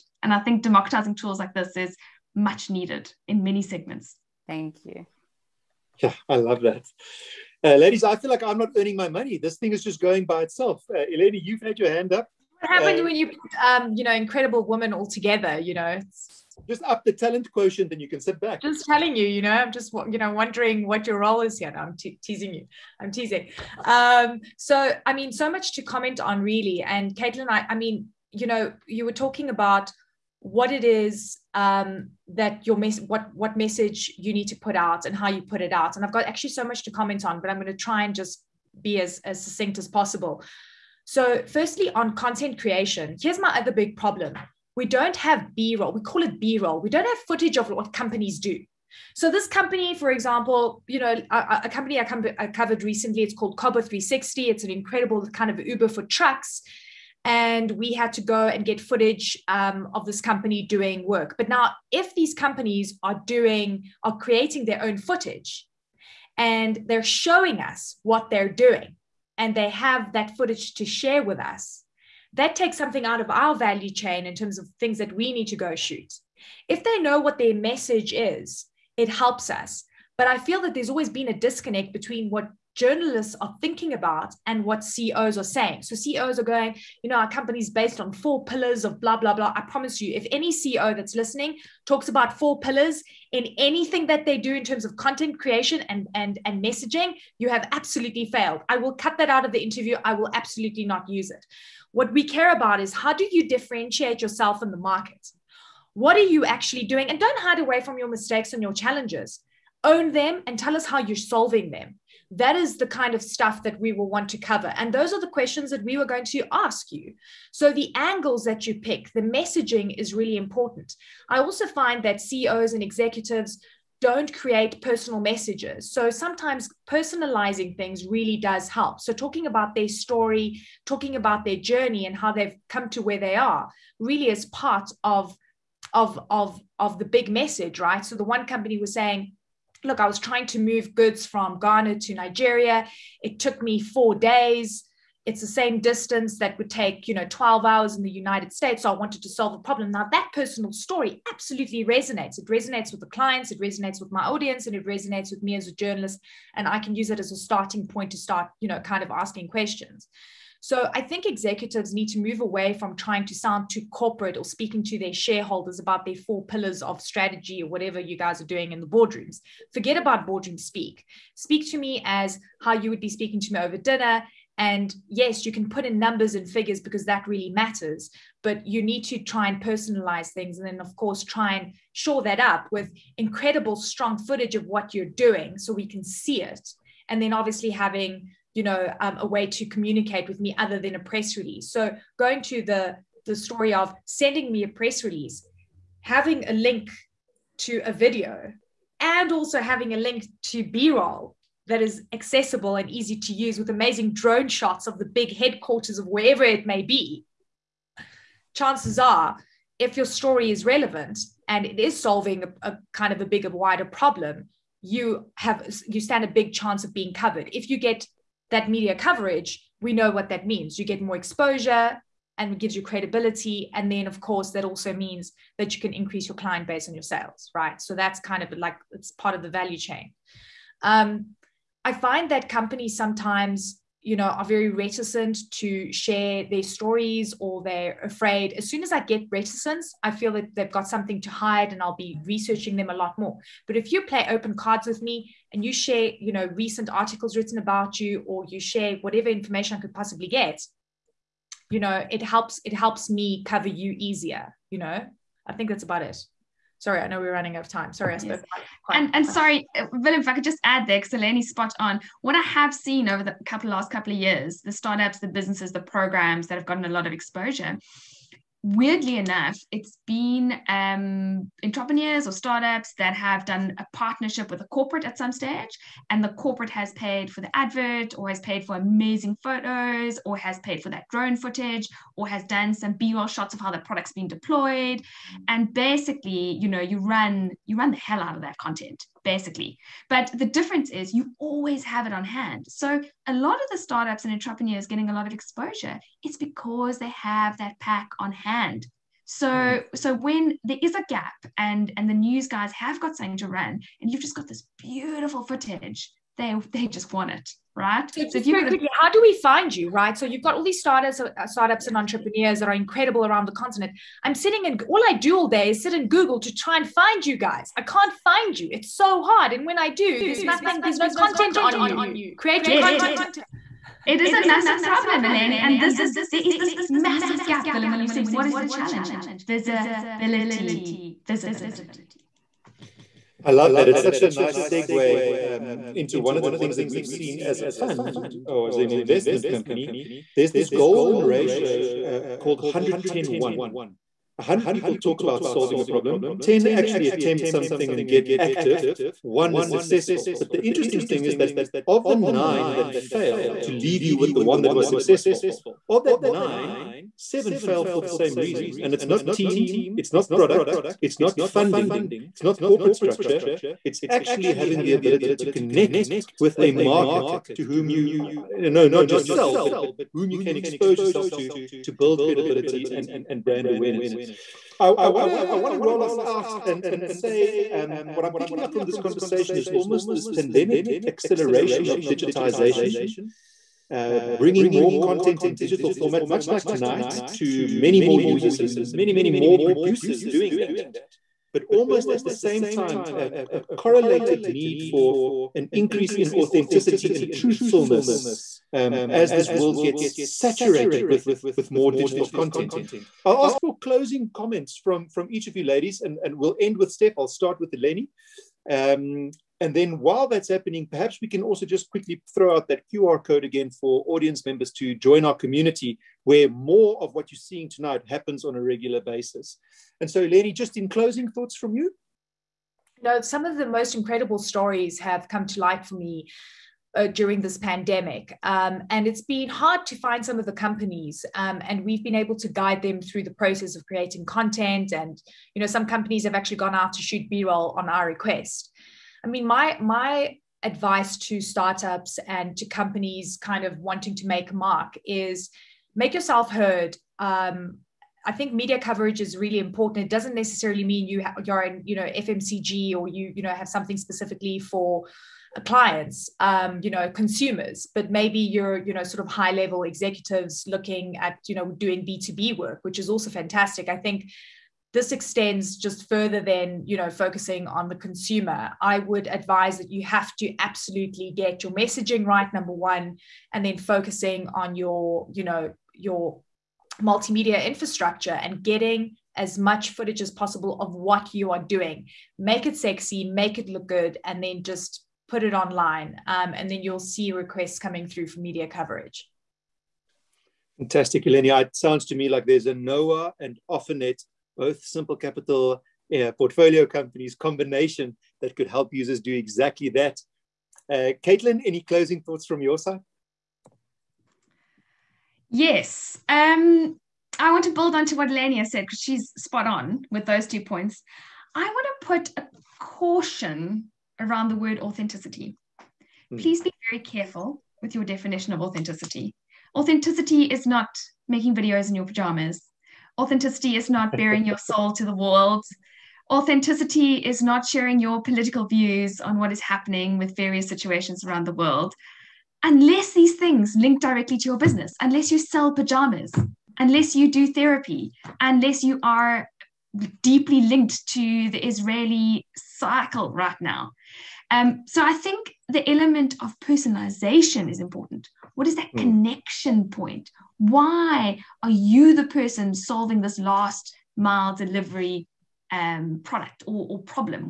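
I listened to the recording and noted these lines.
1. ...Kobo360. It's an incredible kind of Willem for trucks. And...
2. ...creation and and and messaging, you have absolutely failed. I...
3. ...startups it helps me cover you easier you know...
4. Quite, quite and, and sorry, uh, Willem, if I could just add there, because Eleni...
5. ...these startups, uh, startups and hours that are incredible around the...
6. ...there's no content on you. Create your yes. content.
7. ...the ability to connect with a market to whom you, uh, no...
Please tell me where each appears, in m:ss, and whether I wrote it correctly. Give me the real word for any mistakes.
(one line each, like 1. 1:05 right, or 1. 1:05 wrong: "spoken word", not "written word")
1. 0:53 wrong: "Uber", not "Willem"
2. 1:35 right
3. 4:12 wrong: "helps", not "startups"
4. 4:18 right
5. 5:10 wrong: "entrepreneurs", not "hours"
6. 5:20 right
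7. 6:04 right.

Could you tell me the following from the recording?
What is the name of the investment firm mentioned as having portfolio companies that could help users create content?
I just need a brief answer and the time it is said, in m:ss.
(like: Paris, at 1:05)
Simple Capital, at 8:14.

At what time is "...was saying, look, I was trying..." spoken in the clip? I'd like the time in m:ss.
2:18.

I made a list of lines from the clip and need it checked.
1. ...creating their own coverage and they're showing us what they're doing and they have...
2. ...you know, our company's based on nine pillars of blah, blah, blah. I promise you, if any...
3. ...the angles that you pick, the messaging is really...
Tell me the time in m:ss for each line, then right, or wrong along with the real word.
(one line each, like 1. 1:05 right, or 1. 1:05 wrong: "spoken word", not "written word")
1. 1:04 wrong: "footage", not "coverage"
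2. 1:27 wrong: "four", not "nine"
3. 1:57 right.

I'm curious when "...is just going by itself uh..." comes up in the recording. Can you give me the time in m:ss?
0:09.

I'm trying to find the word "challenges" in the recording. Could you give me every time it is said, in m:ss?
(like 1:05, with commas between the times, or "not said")
1:48, 5:28.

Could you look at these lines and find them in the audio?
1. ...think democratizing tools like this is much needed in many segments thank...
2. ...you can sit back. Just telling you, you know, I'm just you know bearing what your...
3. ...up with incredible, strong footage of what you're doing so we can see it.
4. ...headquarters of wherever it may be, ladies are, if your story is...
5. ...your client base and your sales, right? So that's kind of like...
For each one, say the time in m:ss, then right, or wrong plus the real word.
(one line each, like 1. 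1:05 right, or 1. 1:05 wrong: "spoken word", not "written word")
1. 0:00 right
2. 0:17 wrong: "wondering", not "bearing"
3. 3:02 right
4. 3:25 wrong: "chances", not "ladies"
5. 3:46 right.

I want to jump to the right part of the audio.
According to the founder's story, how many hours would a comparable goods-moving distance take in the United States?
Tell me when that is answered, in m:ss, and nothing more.
2:27.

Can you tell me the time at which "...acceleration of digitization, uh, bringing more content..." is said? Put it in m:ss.
6:21.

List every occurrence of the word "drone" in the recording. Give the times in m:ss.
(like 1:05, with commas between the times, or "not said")
3:24, 4:41.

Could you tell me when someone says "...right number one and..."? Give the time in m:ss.
7:52.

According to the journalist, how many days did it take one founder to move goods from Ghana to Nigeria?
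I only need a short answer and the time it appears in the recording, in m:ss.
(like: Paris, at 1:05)
4 days, at 2:23.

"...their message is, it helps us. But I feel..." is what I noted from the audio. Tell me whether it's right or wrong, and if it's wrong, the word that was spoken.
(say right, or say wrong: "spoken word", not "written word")
right.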